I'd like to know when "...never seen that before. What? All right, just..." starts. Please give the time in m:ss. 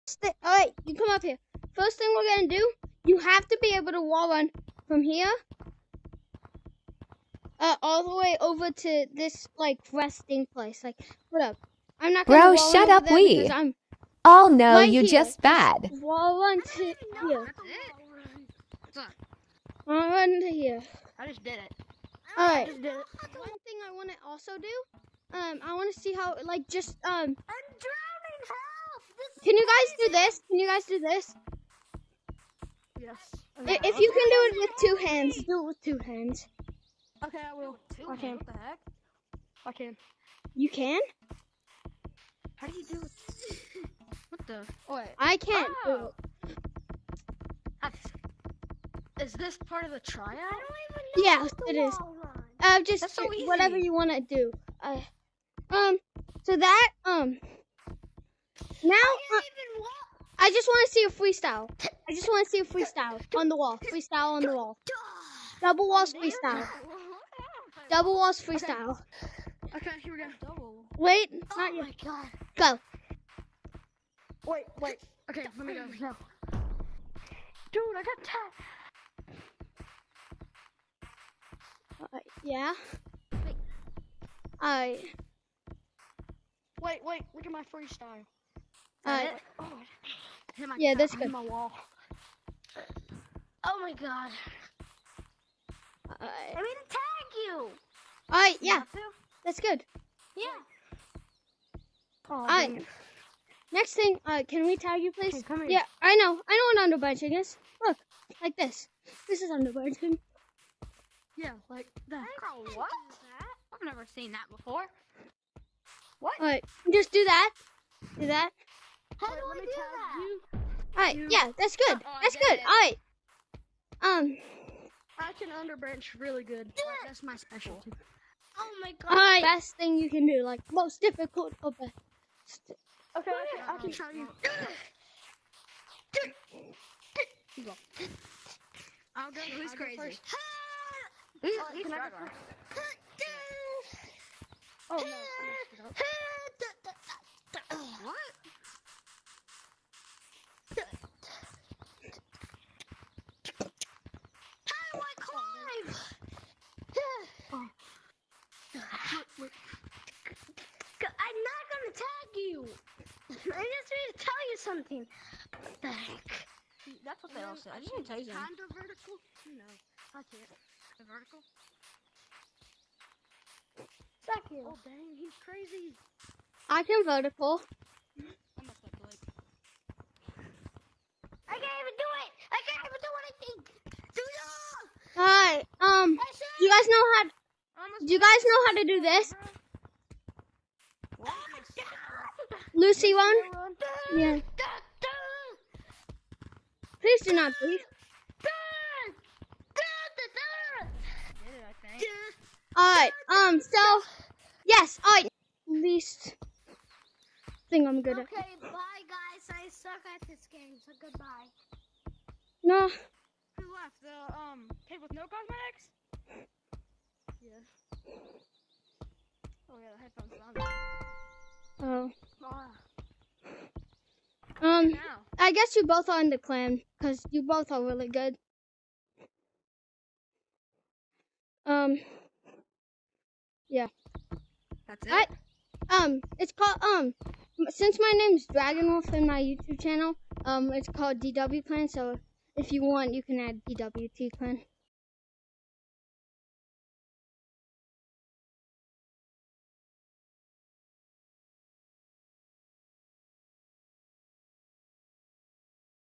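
1:53.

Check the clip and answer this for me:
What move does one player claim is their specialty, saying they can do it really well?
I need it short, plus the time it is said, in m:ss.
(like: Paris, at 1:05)
Underbranch, at 2:05.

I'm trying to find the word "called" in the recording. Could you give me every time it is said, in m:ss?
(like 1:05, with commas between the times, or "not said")
3:56, 4:00.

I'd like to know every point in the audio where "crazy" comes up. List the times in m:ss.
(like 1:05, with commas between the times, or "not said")
2:19, 2:55.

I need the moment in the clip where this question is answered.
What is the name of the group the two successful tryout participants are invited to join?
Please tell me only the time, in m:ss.
4:01.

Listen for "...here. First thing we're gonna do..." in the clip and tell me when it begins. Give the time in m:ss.
0:01.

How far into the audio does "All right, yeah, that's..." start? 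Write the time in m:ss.
1:38.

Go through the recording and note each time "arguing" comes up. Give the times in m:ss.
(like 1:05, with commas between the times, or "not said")
not said.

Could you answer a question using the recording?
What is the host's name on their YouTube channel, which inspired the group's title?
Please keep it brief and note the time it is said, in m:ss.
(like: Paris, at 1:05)
Dragonwolf, at 3:58.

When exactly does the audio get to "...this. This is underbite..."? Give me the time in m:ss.
1:48.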